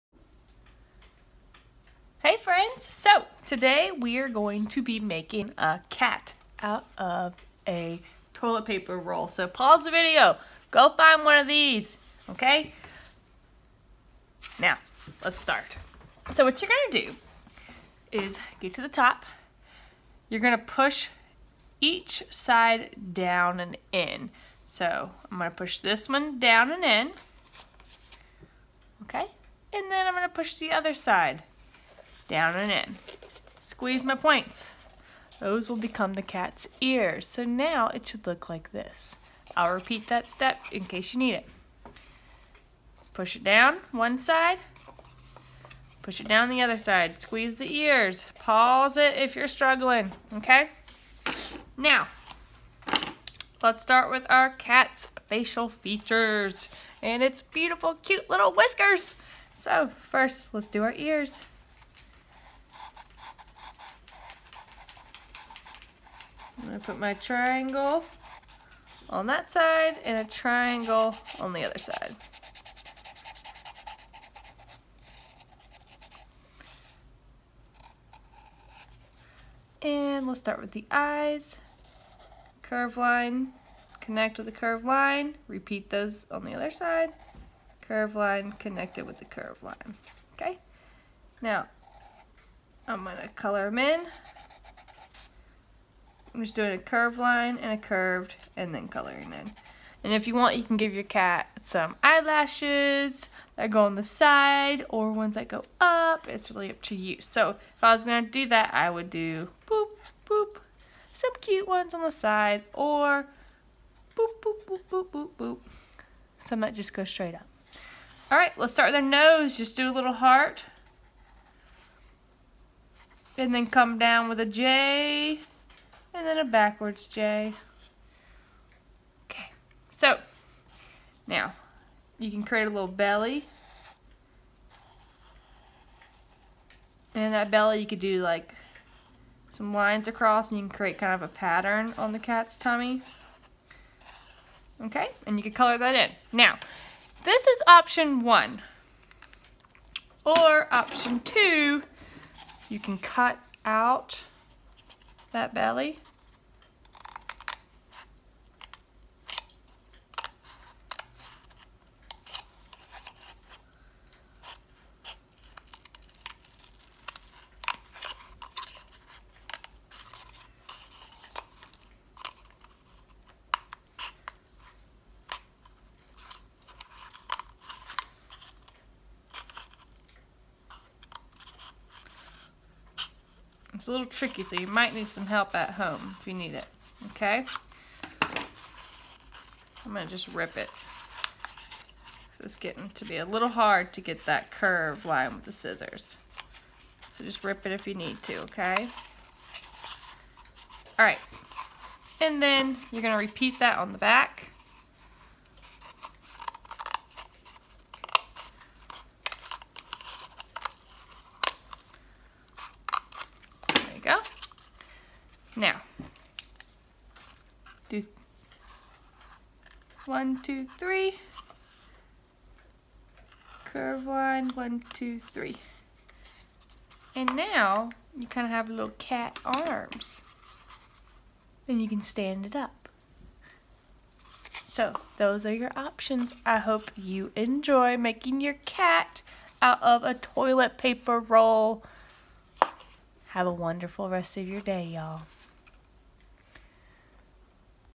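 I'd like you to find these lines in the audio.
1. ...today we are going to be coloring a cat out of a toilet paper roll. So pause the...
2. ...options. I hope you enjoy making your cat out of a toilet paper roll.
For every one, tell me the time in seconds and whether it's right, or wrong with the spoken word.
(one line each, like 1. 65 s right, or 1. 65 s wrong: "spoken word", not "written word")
1. 3 s wrong: "making", not "coloring"
2. 235 s right.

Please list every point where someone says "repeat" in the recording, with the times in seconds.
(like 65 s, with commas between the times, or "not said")
39 s, 85 s, 203 s.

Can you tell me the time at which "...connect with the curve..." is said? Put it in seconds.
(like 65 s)
83 s.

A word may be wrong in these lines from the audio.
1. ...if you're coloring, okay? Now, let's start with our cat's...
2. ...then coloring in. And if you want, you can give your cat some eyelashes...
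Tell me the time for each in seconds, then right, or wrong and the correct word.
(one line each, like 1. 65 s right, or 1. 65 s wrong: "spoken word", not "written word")
1. 49 s wrong: "struggling", not "coloring"
2. 98 s right.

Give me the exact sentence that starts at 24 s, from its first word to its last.
So I'm gonna push this one down and in, okay?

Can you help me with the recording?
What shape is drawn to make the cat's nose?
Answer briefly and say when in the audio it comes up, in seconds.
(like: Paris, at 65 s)
a little heart, at 119 s.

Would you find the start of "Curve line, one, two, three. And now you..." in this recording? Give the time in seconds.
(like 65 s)
223 s.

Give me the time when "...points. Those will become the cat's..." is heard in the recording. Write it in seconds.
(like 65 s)
34 s.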